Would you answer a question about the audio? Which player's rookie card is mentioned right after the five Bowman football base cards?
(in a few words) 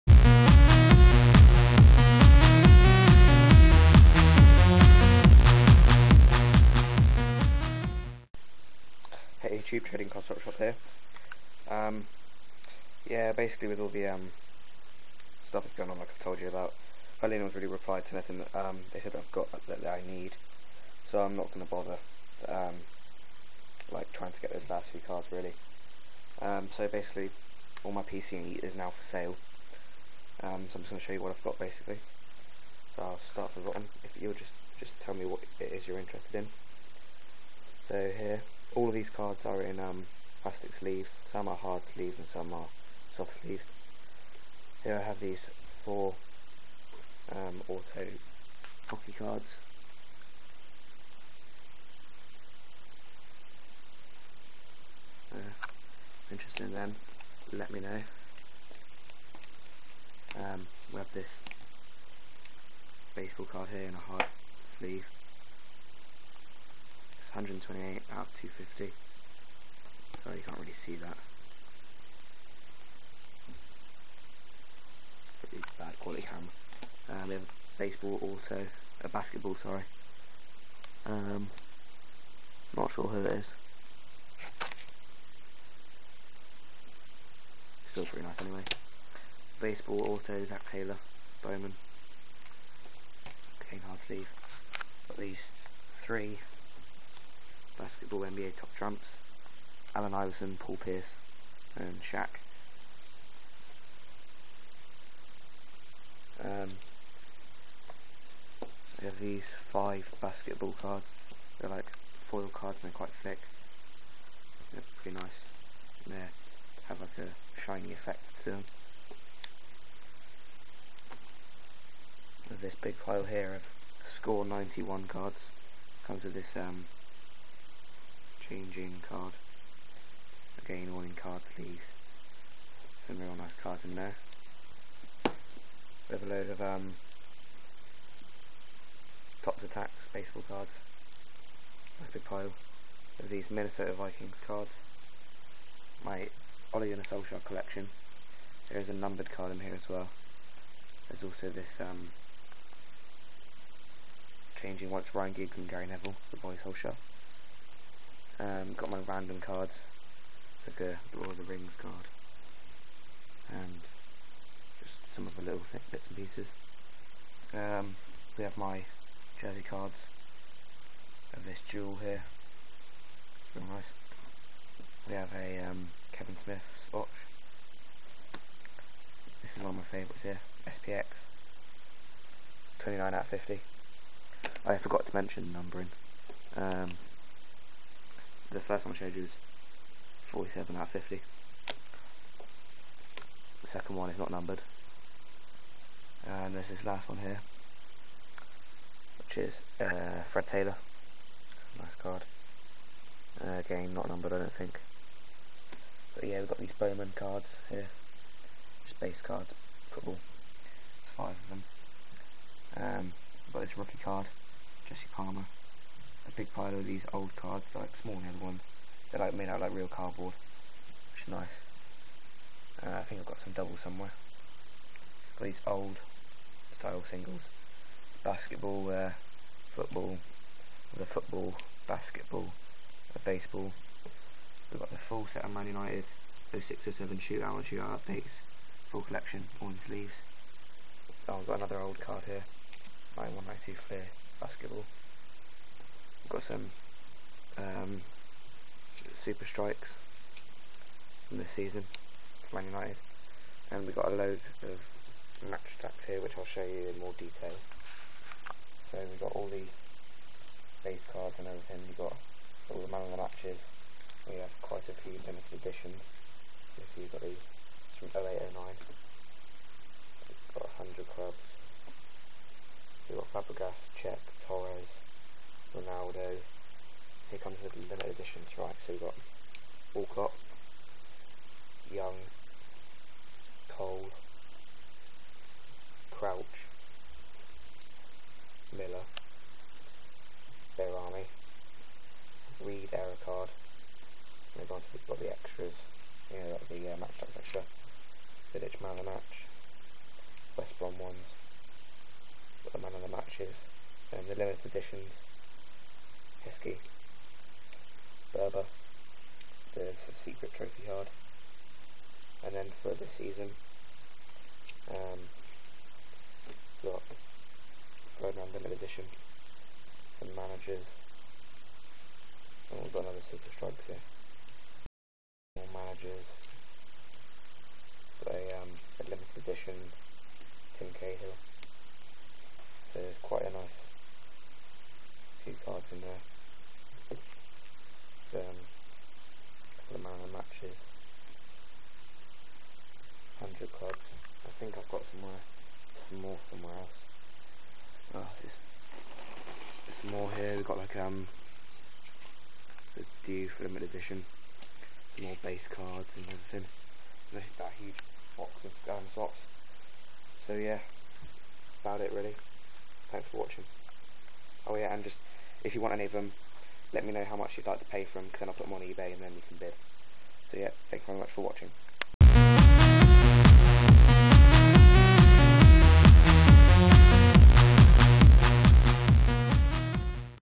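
Jesse Palmer.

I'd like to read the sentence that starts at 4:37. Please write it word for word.
Here comes the limited editions, right?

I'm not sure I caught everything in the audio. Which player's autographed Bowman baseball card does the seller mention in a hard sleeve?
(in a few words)
Zach Taylor.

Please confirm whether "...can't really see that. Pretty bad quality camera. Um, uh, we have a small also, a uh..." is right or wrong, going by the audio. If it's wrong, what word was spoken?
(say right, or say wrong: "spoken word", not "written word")
wrong: "baseball", not "small".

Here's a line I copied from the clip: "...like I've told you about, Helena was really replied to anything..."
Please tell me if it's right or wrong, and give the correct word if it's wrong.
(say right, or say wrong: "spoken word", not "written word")
right.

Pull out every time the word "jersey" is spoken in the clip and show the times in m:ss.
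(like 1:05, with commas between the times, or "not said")
2:49.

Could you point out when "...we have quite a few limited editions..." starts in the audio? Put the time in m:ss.
4:24.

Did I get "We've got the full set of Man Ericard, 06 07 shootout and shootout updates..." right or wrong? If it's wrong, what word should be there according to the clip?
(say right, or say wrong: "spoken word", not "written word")
wrong: "United", not "Ericard".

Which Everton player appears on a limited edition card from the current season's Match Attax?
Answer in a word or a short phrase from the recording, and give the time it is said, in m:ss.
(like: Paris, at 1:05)
Tim Cahill, at 5:30.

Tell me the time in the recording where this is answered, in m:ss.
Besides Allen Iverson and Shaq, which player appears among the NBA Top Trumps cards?
1:40.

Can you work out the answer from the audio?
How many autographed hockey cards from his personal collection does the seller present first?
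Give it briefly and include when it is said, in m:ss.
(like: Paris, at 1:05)
4, at 0:45.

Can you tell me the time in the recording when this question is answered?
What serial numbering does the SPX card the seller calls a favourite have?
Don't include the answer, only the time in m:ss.
3:02.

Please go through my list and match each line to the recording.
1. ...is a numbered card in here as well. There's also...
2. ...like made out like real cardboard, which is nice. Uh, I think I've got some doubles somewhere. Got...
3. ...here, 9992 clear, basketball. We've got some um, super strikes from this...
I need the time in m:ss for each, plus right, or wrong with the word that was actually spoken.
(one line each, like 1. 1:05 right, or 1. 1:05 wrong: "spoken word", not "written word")
1. 2:28 right
2. 3:39 right
3. 4:02 wrong: "9192", not "9992".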